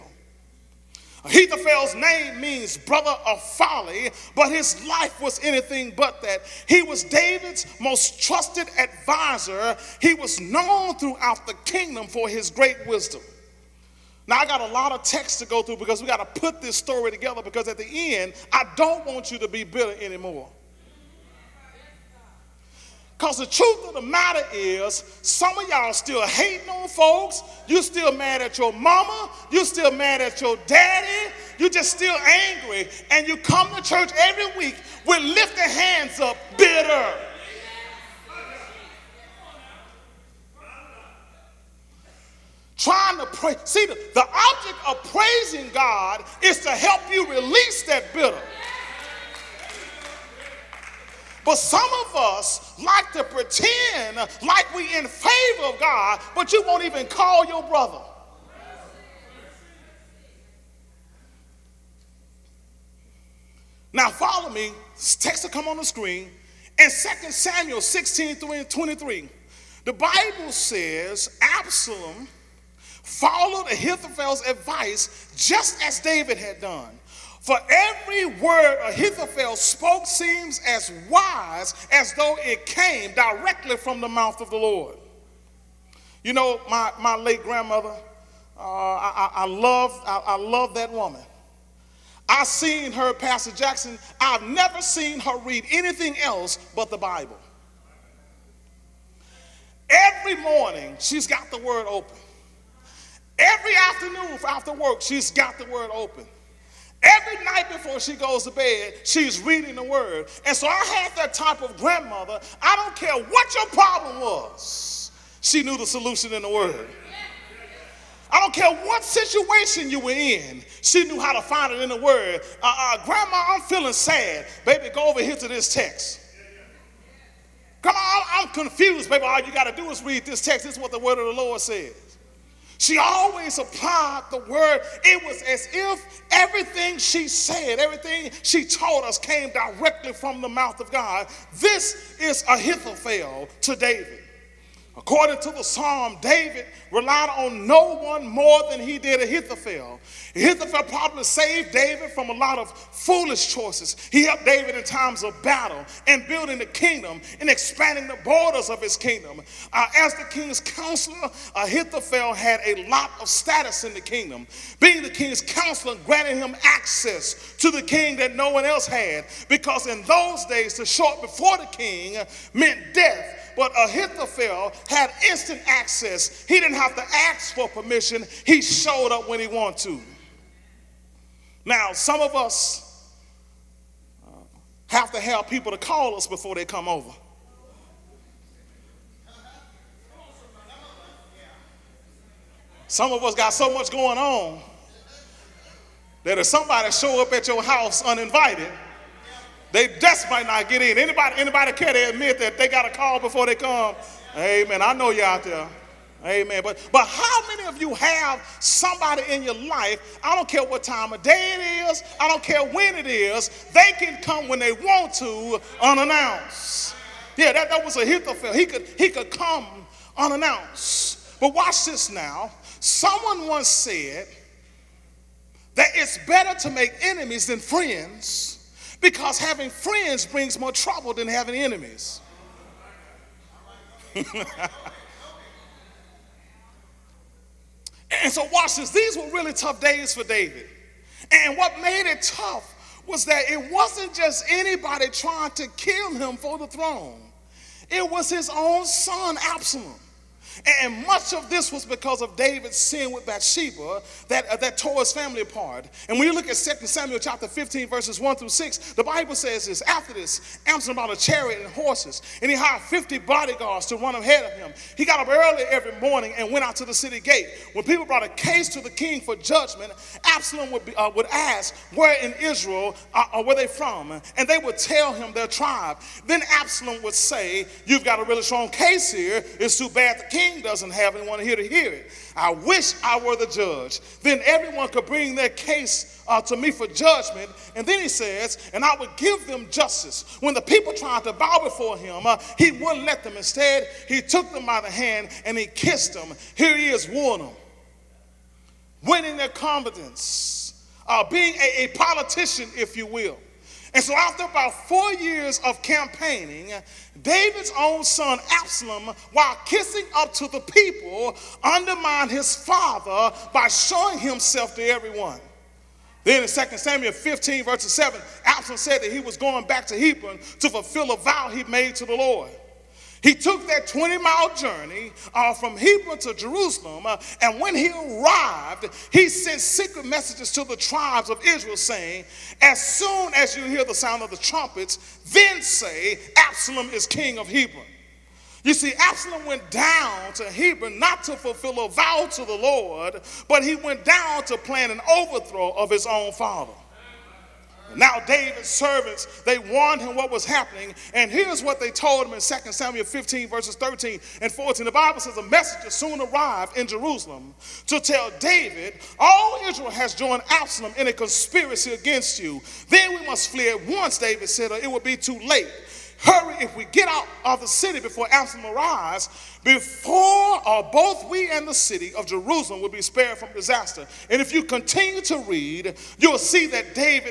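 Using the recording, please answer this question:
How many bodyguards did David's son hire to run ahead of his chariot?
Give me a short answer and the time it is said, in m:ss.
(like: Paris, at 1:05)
50, at 4:22.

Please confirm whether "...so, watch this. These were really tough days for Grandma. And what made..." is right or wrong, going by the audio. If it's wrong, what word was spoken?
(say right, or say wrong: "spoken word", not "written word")
wrong: "David", not "Grandma".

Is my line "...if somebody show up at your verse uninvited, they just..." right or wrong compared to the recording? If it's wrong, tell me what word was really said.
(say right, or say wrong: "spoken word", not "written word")
wrong: "house", not "verse".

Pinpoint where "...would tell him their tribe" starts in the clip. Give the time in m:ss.
4:34.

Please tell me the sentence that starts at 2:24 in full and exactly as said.
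According to the psalm, David relied on no one more than he did Ahithophel.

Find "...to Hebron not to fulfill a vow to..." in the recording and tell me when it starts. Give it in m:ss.
5:40.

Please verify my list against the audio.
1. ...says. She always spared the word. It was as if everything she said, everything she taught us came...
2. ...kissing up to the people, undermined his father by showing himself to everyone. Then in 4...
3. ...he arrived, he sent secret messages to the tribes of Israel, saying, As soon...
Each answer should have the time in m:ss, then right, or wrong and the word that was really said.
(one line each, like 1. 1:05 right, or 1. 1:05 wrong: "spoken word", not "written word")
1. 2:11 wrong: "applied", not "spared"
2. 5:09 wrong: "2", not "4"
3. 5:27 right.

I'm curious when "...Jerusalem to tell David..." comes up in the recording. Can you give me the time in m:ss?
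5:56.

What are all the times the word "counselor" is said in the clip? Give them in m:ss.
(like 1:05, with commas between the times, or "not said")
2:40, 2:45.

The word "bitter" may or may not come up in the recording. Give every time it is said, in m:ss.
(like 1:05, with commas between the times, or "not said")
0:19, 0:36, 0:48.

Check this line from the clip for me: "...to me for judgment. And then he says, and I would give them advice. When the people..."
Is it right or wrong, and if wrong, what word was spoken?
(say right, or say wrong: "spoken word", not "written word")
wrong: "justice", not "advice".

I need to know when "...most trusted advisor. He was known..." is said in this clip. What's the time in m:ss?
0:07.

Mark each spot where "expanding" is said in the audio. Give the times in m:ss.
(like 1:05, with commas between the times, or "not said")
2:37.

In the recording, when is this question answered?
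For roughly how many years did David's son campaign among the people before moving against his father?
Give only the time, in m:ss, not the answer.
5:04.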